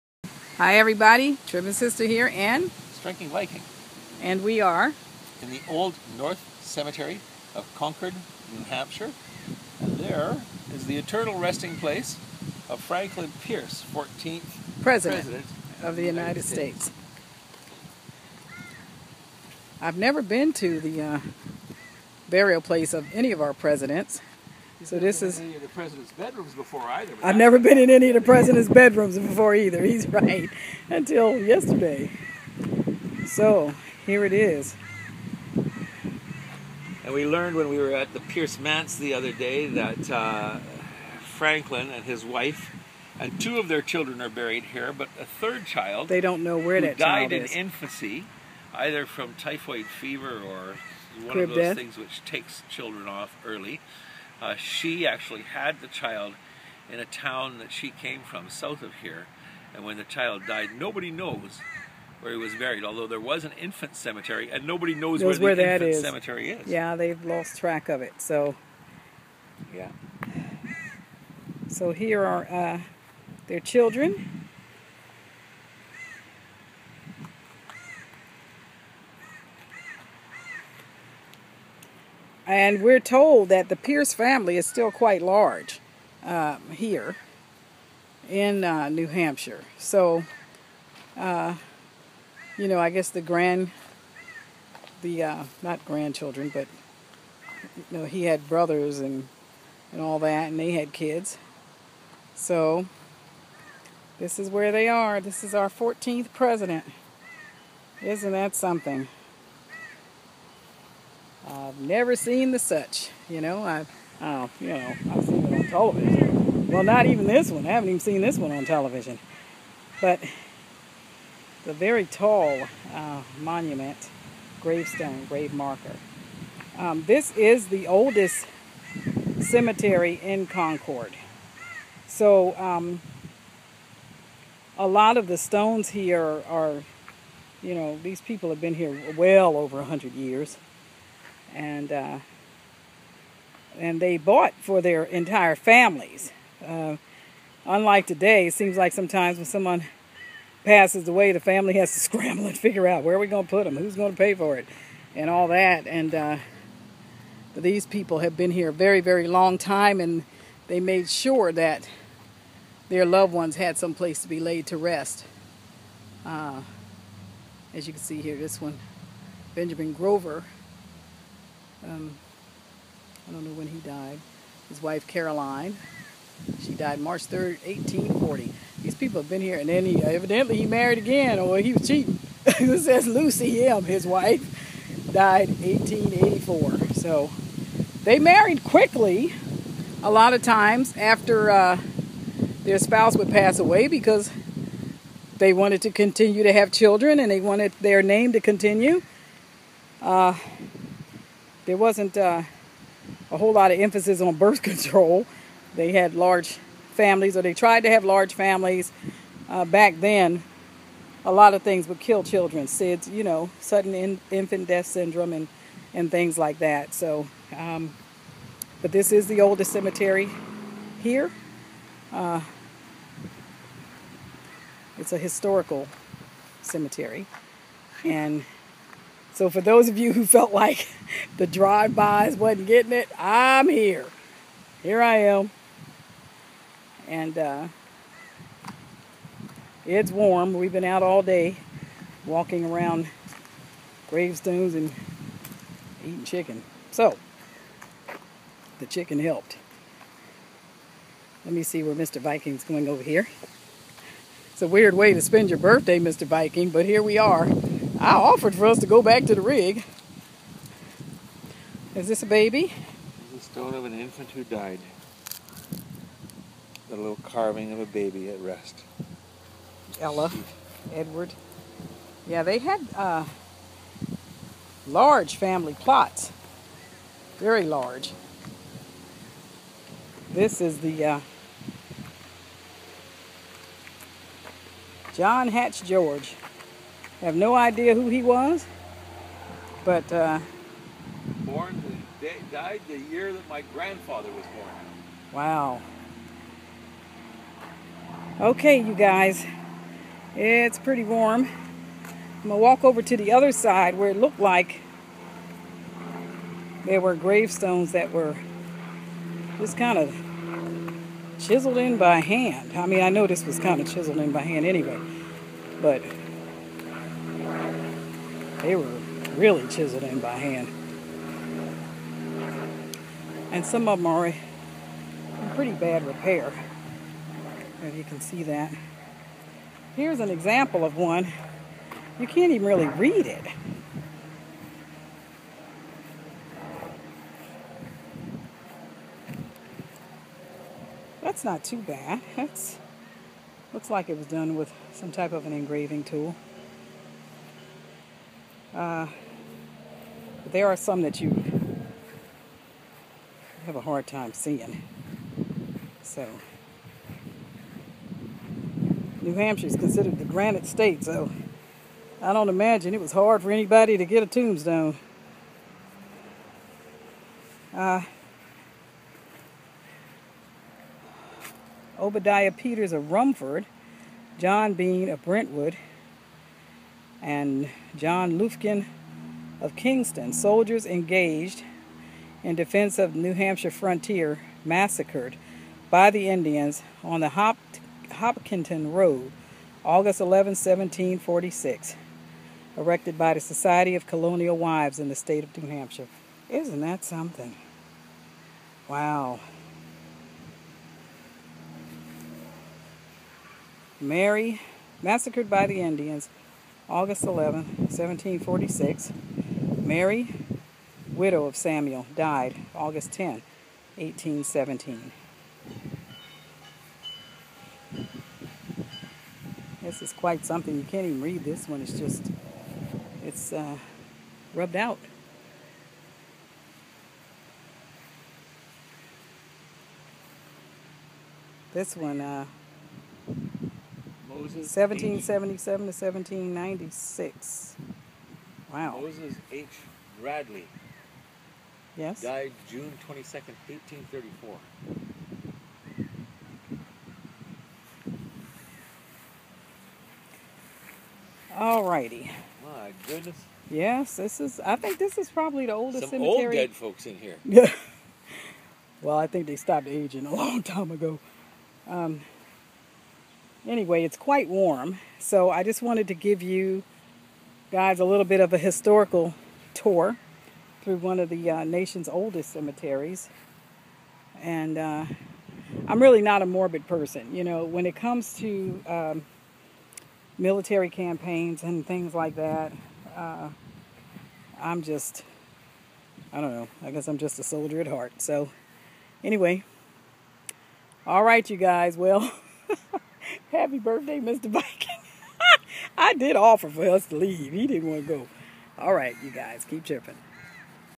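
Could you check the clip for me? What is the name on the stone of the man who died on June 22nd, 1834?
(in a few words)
Moses H. Bradley.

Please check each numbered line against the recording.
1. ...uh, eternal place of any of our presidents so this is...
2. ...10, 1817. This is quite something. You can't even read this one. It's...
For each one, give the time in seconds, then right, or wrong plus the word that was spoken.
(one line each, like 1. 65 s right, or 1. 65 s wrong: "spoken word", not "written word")
1. 21 s wrong: "burial", not "eternal"
2. 413 s right.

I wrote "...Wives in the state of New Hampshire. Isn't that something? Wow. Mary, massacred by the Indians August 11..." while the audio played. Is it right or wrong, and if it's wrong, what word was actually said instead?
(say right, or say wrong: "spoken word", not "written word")
right.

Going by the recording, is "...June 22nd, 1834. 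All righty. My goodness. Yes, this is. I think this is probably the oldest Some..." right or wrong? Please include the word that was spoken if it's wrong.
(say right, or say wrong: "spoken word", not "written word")
right.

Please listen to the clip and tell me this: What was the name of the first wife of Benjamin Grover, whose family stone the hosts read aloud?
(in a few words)
Caroline.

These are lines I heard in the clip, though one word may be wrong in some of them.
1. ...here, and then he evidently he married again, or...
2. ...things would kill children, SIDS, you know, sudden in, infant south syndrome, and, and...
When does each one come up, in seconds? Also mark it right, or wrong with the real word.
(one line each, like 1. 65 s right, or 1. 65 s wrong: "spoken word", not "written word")
1. 179 s right
2. 211 s wrong: "death", not "south".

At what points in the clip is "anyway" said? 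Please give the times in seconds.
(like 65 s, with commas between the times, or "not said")
314 s, 463 s, 489 s.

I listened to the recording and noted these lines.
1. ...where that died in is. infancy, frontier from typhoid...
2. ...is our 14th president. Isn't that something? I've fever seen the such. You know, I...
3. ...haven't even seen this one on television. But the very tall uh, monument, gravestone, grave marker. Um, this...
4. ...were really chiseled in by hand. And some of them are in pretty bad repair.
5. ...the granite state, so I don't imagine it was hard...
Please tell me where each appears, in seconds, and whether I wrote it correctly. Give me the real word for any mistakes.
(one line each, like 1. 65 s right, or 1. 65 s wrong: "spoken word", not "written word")
1. 46 s wrong: "either", not "frontier"
2. 105 s wrong: "never", not "fever"
3. 117 s right
4. 318 s right
5. 360 s right.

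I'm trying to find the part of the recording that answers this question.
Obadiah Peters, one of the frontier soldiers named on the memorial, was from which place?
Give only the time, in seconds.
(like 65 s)
373 s.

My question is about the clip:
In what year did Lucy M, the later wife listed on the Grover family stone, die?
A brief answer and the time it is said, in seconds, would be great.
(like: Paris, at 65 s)
1884, at 185 s.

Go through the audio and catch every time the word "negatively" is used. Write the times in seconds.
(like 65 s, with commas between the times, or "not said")
not said.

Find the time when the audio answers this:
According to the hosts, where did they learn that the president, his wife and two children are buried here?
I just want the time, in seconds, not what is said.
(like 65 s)
38 s.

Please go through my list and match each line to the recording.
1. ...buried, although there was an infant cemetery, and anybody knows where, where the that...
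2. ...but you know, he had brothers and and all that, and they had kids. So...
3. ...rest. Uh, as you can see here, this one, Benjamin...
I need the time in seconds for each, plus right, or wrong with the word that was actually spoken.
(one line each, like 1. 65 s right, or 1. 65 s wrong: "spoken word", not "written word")
1. 62 s wrong: "nobody", not "anybody"
2. 96 s right
3. 164 s right.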